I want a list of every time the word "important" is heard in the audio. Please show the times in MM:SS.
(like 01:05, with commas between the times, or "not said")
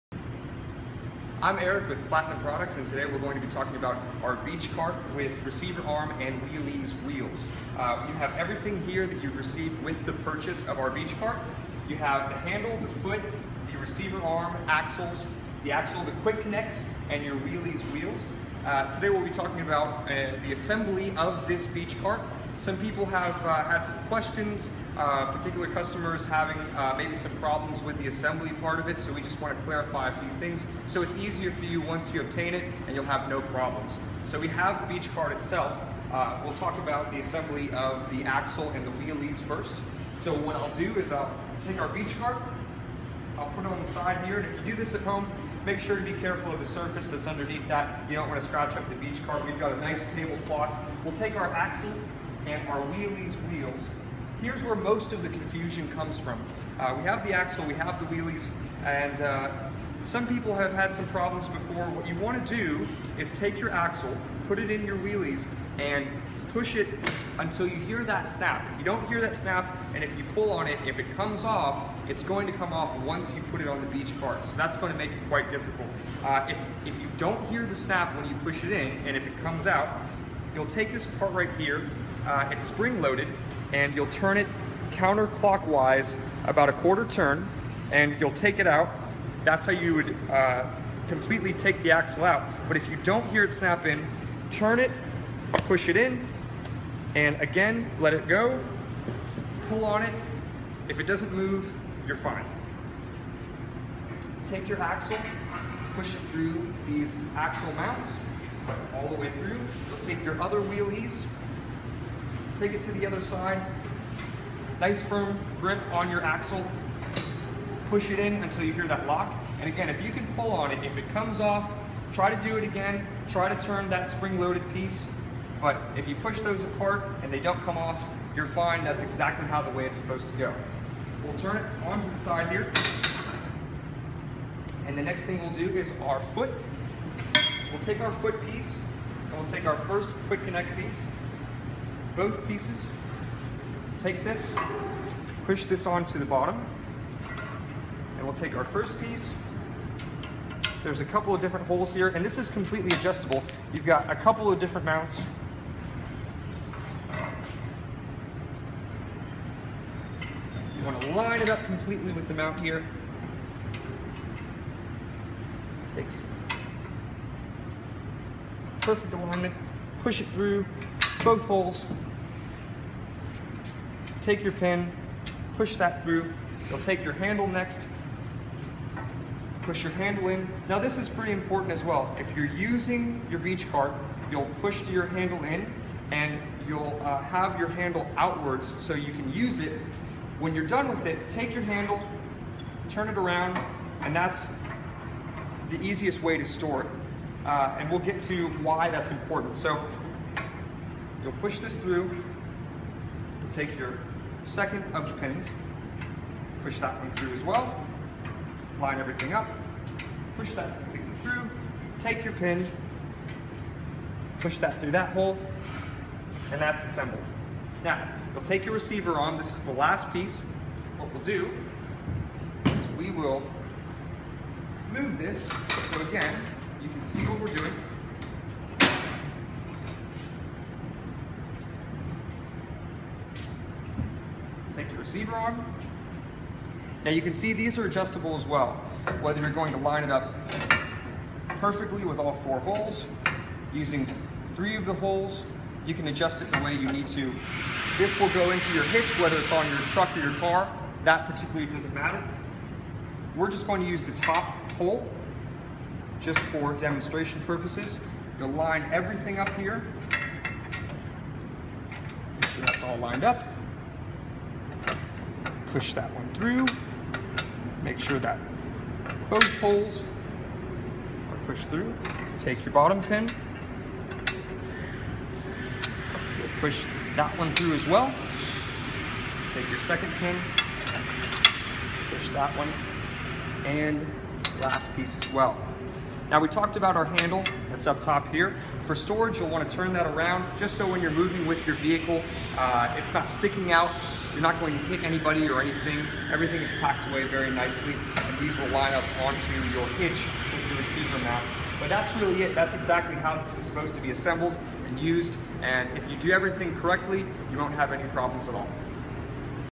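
03:01, 03:19.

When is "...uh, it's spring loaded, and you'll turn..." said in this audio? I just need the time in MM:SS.
01:22.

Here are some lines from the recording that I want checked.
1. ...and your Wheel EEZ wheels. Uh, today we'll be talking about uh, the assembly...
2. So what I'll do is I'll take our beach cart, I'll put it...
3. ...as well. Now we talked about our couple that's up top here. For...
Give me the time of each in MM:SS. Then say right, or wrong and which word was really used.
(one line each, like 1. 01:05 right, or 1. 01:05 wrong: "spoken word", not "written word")
1. 00:17 right
2. 00:40 right
3. 04:45 wrong: "handle", not "couple".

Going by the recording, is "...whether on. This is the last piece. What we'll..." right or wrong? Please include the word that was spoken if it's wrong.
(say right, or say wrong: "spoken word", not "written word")
wrong: "receiver", not "whether".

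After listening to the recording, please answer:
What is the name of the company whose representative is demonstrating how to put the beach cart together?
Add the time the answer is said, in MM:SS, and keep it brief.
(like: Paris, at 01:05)
Plattinum Products, at 00:02.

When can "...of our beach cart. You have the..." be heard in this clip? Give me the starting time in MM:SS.
00:10.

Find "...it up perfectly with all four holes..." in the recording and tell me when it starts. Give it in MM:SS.
04:00.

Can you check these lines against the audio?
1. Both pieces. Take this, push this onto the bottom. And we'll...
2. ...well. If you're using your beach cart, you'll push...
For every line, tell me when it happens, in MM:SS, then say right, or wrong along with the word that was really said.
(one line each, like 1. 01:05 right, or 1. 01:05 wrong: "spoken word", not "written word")
1. 02:22 right
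2. 03:01 right.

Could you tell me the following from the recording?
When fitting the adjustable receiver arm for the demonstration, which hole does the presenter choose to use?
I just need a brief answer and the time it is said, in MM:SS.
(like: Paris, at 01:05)
The top hole, at 04:14.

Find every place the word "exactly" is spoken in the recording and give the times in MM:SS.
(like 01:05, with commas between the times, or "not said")
02:09, 05:02.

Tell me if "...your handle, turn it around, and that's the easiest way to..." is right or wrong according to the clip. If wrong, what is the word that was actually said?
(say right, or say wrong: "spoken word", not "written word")
right.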